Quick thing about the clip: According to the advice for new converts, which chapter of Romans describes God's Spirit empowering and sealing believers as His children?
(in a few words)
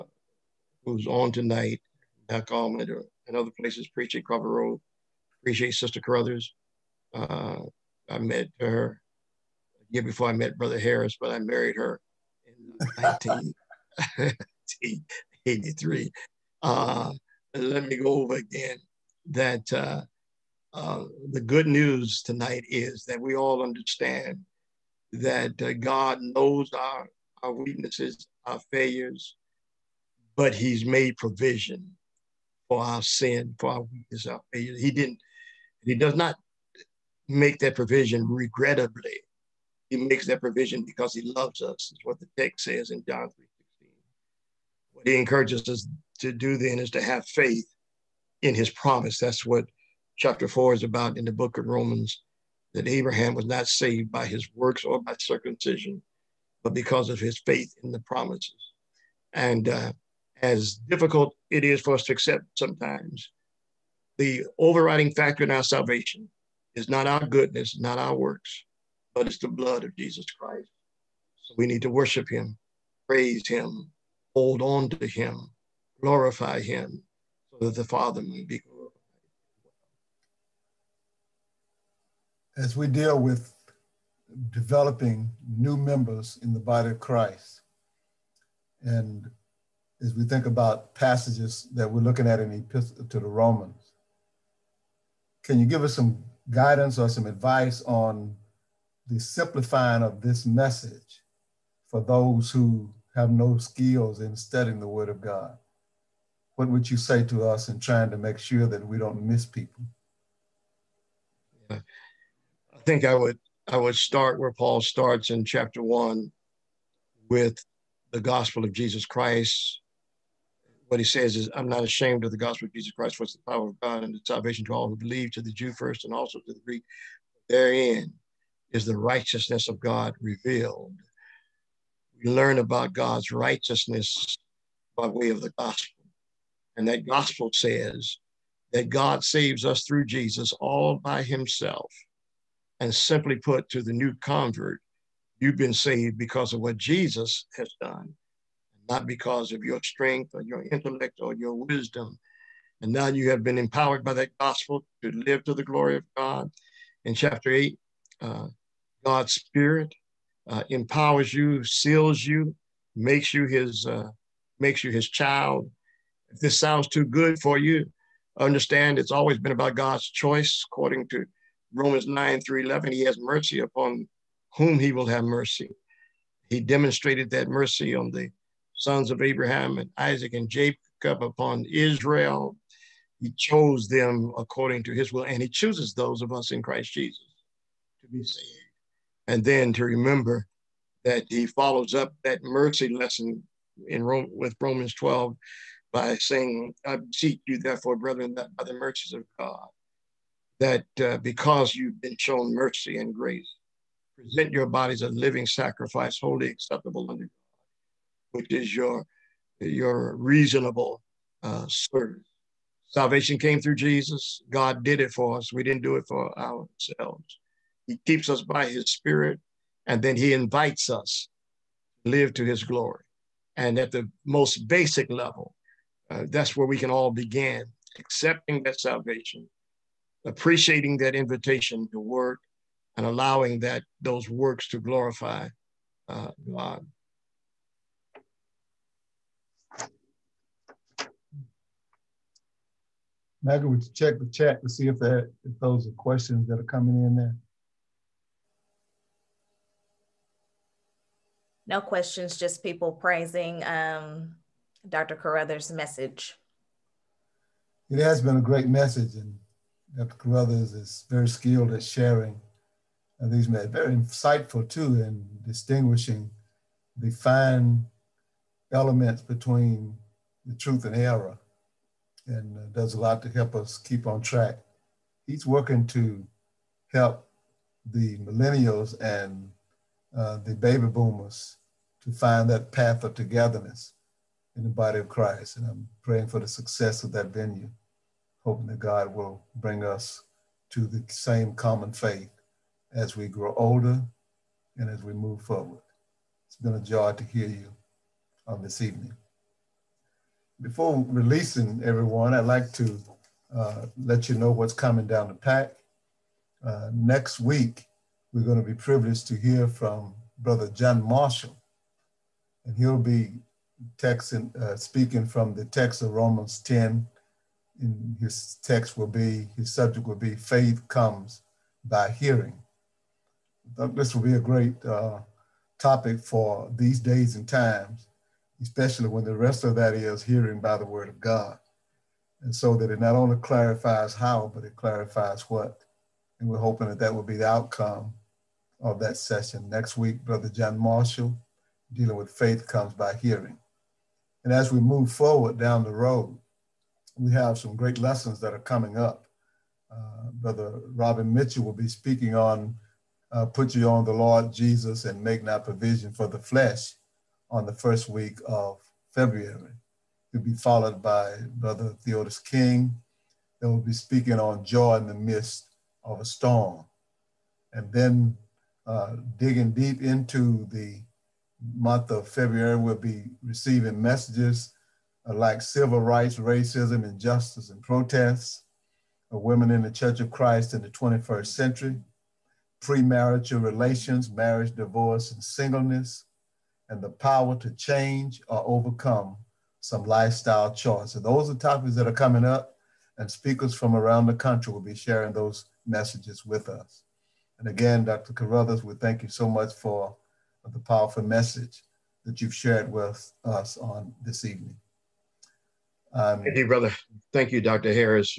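Chapter 8.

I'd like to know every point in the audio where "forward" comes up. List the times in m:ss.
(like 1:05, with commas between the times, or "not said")
4:55, 5:45.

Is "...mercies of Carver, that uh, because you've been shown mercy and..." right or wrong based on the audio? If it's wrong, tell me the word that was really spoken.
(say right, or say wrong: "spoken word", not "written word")
wrong: "God", not "Carver".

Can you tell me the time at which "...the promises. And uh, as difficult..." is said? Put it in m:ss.
0:57.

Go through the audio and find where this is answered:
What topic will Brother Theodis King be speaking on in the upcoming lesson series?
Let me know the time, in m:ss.
6:04.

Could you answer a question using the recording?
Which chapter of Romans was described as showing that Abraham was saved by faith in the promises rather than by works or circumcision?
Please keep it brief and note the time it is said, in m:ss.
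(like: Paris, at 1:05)
Chapter 4, at 0:50.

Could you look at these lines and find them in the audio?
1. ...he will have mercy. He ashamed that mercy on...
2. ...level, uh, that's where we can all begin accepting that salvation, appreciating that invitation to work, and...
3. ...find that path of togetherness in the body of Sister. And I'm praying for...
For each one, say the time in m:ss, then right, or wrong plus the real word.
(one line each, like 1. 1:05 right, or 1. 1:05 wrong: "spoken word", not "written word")
1. 2:54 wrong: "demonstrated", not "ashamed"
2. 3:45 right
3. 4:42 wrong: "Christ", not "Sister".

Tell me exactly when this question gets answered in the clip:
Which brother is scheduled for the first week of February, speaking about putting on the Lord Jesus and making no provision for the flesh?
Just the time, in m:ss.
5:50.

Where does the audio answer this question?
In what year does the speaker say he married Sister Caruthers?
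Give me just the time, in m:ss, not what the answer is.
0:13.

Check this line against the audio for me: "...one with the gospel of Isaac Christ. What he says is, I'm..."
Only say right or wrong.
wrong.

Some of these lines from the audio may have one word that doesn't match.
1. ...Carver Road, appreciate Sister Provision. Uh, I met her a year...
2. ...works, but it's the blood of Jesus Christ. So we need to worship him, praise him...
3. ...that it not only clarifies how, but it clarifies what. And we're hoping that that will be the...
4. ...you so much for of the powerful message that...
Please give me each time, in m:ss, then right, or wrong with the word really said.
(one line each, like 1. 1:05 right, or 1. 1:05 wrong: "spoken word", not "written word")
1. 0:04 wrong: "Caruthers", not "Provision"
2. 1:08 right
3. 5:32 right
4. 6:39 right.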